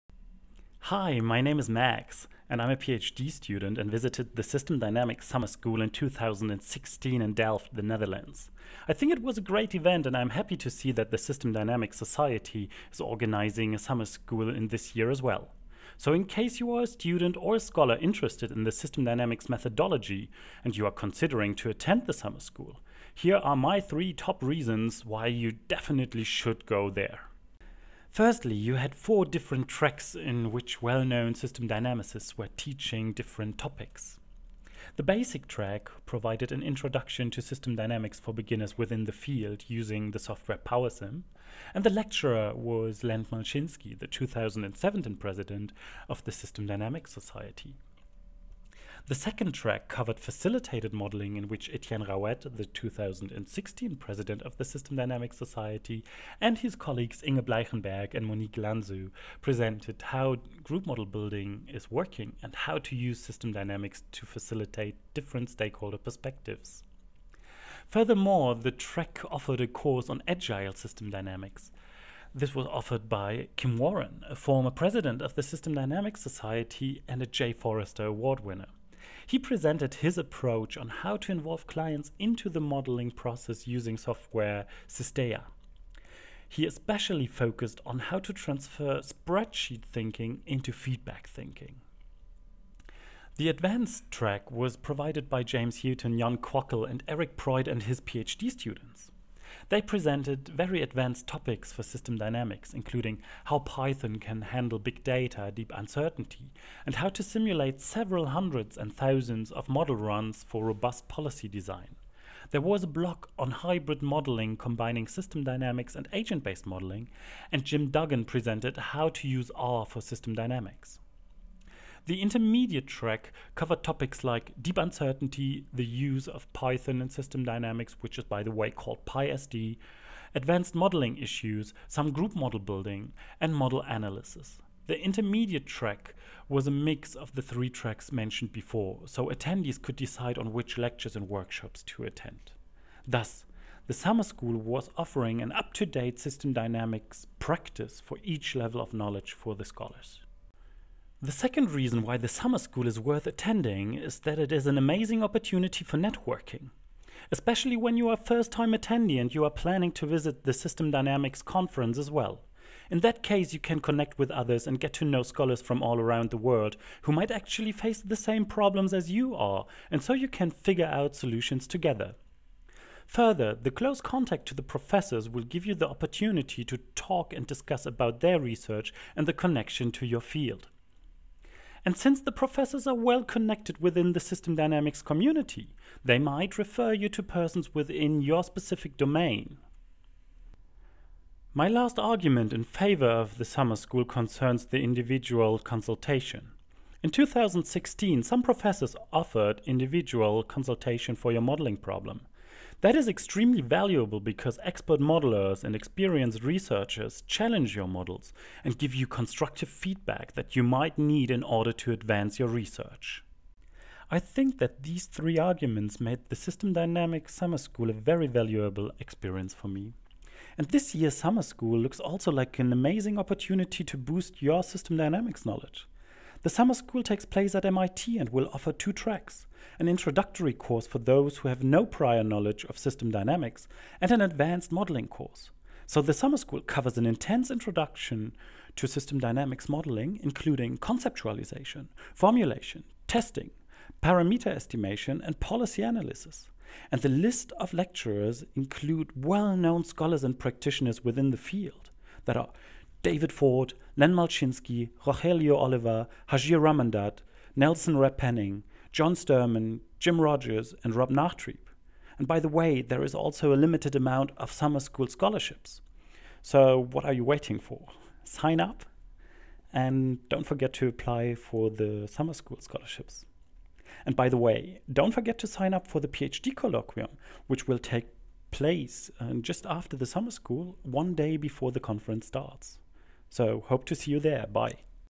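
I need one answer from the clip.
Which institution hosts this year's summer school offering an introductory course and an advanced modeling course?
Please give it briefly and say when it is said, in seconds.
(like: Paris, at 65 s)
MIT, at 227 s.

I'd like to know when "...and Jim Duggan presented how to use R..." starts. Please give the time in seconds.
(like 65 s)
117 s.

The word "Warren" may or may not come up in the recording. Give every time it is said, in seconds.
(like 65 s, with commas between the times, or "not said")
73 s.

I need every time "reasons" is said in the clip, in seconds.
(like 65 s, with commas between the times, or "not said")
24 s, 151 s.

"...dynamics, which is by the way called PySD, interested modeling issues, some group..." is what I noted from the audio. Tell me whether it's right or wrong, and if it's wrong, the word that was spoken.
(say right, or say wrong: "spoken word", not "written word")
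wrong: "advanced", not "interested".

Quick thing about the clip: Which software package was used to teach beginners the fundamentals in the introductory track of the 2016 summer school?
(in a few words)
PowerSim.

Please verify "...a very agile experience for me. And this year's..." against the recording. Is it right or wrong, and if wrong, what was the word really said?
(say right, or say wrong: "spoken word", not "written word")
wrong: "valuable", not "agile".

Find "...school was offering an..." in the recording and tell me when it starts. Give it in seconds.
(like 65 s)
144 s.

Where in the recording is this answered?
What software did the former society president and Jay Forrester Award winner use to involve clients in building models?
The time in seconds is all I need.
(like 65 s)
84 s.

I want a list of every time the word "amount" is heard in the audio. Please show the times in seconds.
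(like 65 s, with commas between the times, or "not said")
263 s.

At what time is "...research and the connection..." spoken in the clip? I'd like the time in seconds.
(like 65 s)
178 s.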